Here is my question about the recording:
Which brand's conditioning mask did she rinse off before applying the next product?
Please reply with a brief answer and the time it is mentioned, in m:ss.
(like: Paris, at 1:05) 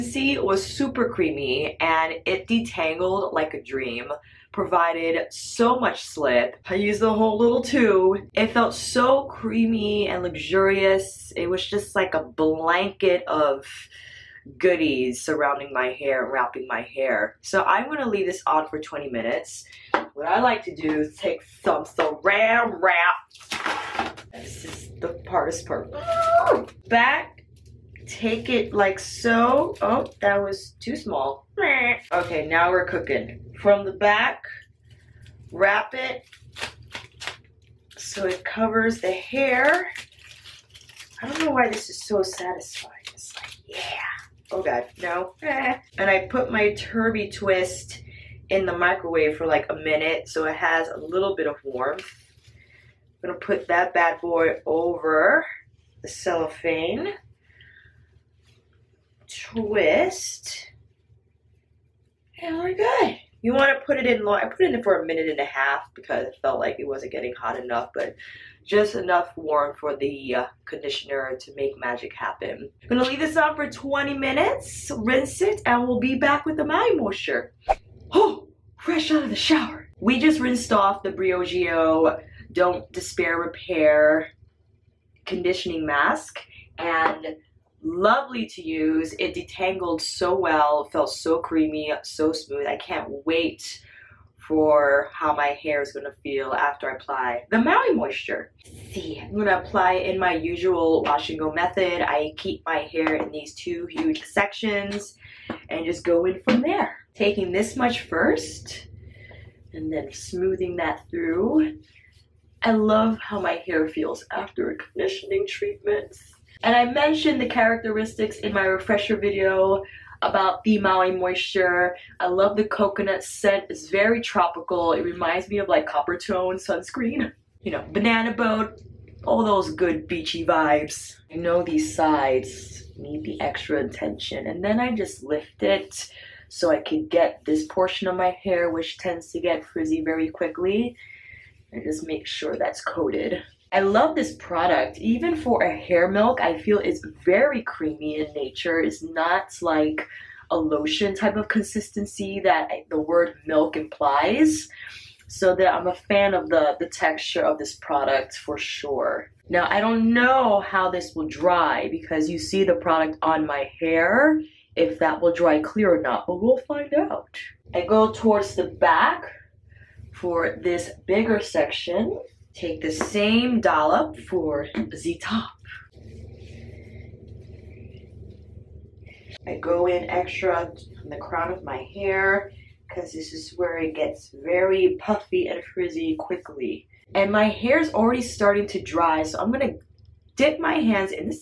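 Briogeo, at 1:21.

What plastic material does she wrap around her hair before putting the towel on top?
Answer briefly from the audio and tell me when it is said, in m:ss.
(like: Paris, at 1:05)
Saran wrap, at 0:21.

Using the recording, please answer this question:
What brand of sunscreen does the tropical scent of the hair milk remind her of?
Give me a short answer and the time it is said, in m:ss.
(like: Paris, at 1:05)
Coppertone, at 2:05.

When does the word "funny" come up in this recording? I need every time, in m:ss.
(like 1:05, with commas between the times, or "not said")
not said.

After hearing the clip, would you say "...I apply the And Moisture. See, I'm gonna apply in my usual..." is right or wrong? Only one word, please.
wrong.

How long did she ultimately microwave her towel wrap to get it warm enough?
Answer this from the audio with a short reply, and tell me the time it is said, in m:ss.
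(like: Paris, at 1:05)
1.5 minutes, at 1:05.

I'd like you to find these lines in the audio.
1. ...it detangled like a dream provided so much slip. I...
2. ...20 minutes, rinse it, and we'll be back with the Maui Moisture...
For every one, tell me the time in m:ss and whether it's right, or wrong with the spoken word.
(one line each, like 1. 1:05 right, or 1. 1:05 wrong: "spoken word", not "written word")
1. 0:02 right
2. 1:13 right.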